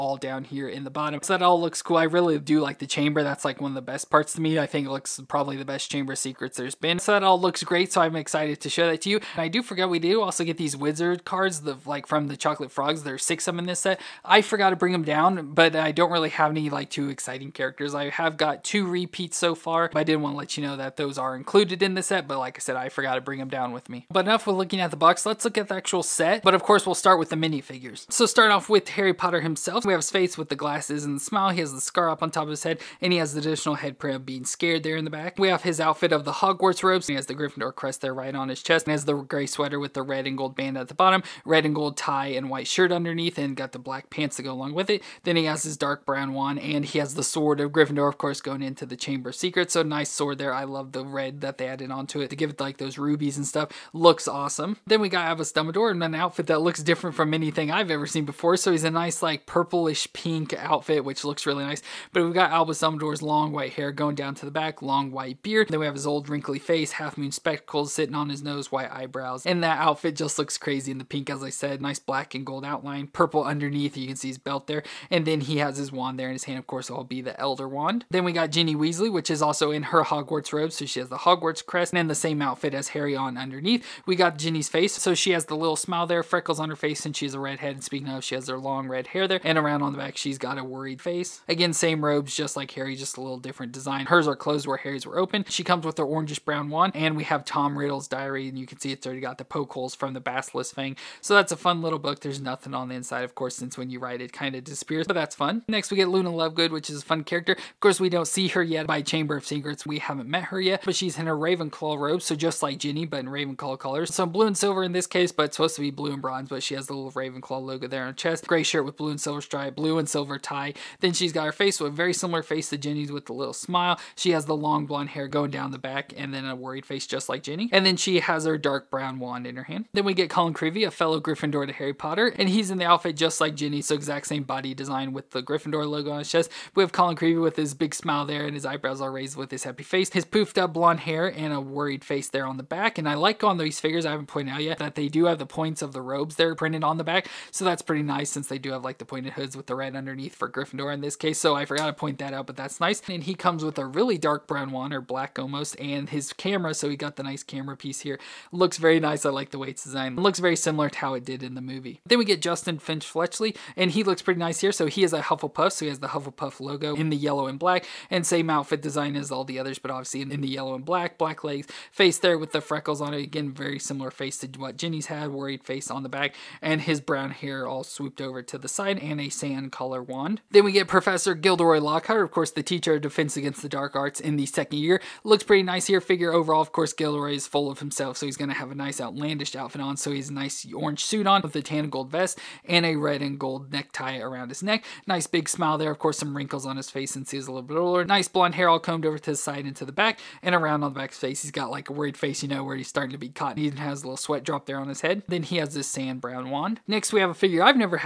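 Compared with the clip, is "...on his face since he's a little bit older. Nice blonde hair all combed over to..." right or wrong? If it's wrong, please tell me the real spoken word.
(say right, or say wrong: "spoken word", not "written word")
right.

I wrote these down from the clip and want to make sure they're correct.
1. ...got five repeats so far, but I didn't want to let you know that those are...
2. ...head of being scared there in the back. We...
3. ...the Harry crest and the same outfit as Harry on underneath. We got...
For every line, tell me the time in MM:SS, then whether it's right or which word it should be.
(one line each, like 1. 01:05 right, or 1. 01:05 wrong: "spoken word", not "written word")
1. 00:18 wrong: "two", not "five"
2. 00:33 right
3. 01:21 wrong: "Hogwarts", not "Harry".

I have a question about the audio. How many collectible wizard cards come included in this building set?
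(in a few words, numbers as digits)
6.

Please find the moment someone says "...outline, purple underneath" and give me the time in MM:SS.
01:12.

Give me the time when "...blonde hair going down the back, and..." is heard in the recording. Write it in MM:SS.
02:04.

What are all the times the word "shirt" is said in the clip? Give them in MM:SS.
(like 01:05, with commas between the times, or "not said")
00:42, 01:58.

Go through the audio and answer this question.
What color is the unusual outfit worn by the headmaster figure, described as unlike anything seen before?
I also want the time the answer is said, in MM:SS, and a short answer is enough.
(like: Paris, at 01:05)
purplish pink, at 00:59.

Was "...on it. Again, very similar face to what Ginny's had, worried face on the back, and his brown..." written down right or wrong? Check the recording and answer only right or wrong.
right.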